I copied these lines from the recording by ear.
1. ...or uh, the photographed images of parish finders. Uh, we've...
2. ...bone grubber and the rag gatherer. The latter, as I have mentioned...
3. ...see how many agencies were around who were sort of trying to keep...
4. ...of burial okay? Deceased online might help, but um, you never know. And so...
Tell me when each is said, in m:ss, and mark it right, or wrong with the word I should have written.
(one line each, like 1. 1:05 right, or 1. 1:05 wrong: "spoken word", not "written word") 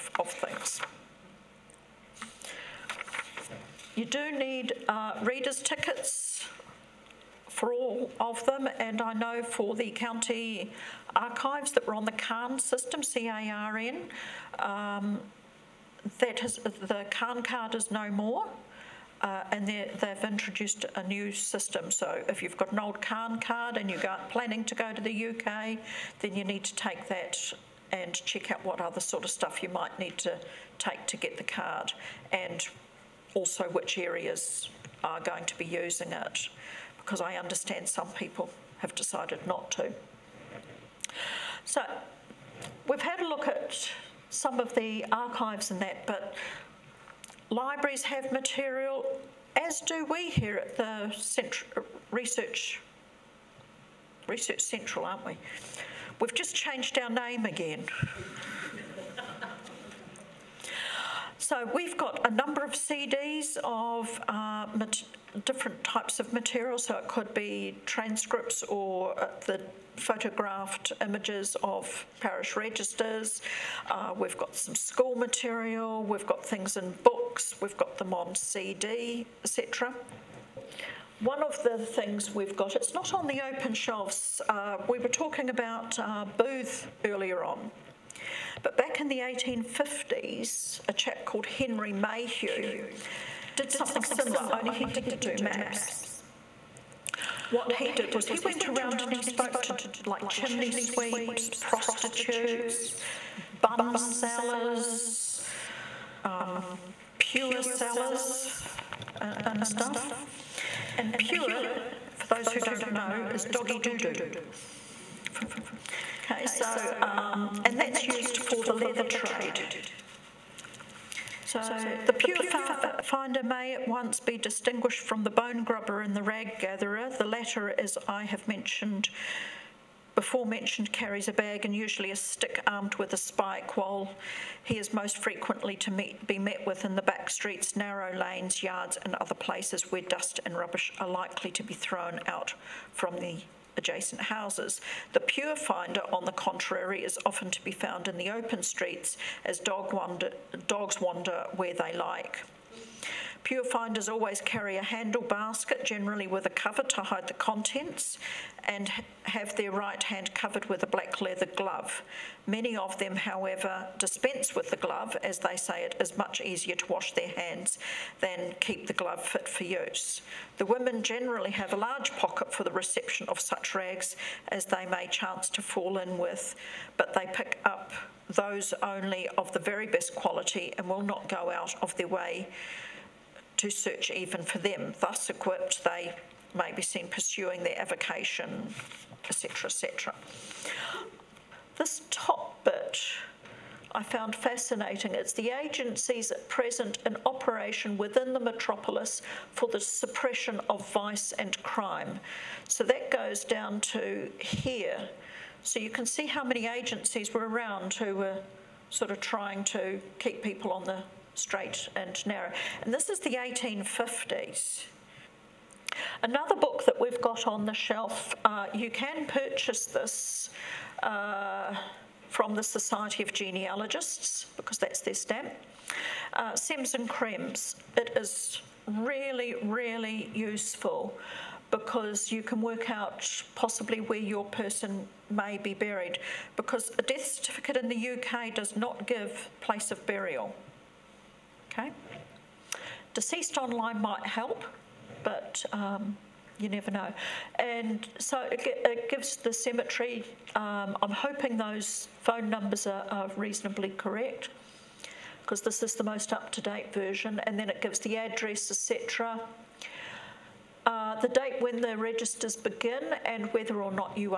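1. 1:08 wrong: "registers", not "finders"
2. 2:05 right
3. 3:26 right
4. 3:59 right.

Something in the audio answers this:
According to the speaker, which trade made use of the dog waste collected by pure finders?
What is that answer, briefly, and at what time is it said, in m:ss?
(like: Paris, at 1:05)
the leather trade, at 1:58.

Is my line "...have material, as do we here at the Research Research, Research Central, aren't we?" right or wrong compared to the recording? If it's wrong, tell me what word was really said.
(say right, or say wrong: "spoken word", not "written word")
wrong: "Cent", not "Research".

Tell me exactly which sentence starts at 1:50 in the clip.
And pure, for those who don't know, is doggy doo doo.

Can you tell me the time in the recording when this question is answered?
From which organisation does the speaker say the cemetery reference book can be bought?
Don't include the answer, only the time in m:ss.
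3:42.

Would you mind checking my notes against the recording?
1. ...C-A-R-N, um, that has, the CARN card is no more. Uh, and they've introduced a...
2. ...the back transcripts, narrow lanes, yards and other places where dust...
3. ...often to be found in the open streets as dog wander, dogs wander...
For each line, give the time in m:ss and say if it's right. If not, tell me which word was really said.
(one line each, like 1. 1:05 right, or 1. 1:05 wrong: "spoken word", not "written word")
1. 0:13 right
2. 2:16 wrong: "streets", not "transcripts"
3. 2:27 right.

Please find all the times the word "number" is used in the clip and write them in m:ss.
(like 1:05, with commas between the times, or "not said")
1:02, 4:12.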